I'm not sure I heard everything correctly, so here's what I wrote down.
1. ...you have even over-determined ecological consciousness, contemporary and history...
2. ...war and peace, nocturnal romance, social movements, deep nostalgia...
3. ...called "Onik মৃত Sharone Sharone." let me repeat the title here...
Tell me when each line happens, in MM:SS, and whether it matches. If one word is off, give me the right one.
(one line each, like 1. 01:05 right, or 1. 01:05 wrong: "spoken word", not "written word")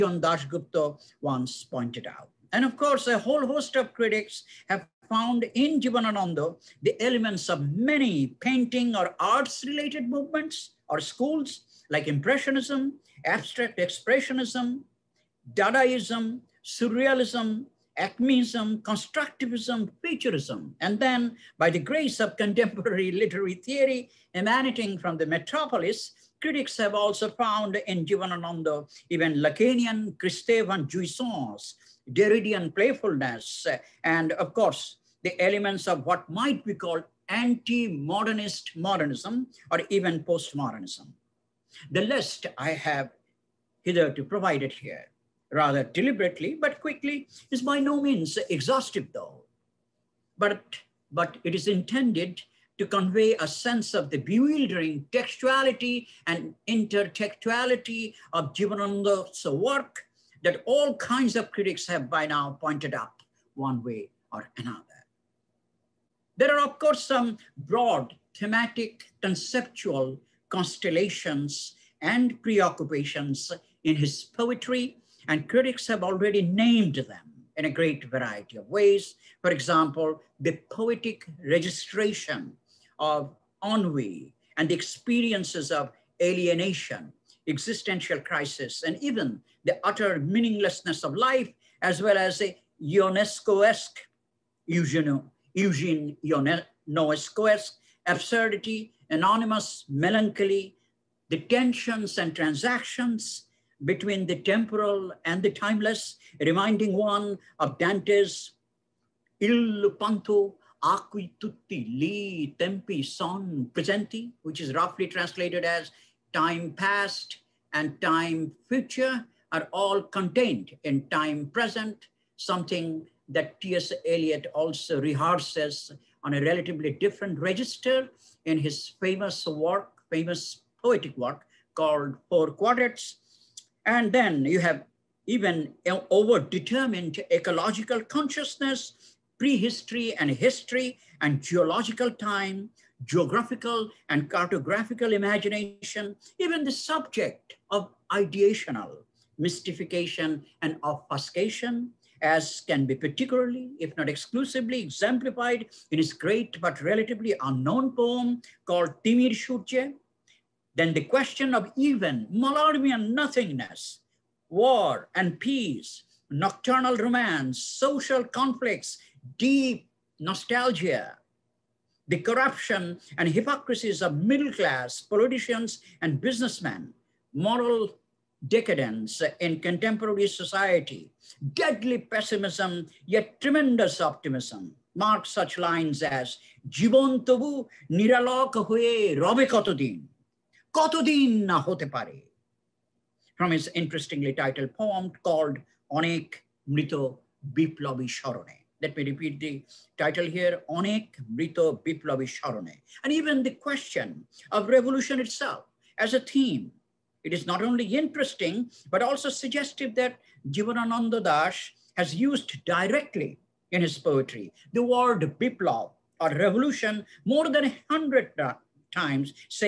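1. 02:14 wrong: "prehistory", not "contemporary"
2. 02:44 wrong: "conflicts", not "movements"
3. 03:15 wrong: "Biplobi", not "Sharone".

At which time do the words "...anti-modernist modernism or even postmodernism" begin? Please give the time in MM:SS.
00:37.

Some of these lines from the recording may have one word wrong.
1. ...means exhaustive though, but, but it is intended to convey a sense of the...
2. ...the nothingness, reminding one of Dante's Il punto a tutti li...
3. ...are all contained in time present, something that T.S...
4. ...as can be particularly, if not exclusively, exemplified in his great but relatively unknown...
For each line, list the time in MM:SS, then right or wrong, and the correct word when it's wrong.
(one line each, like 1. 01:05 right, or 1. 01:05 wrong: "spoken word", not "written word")
1. 00:48 right
2. 01:45 wrong: "timeless", not "nothingness"
3. 01:59 right
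4. 02:32 right.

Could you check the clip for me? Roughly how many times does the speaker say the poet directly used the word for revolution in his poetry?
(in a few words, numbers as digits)
more than 100.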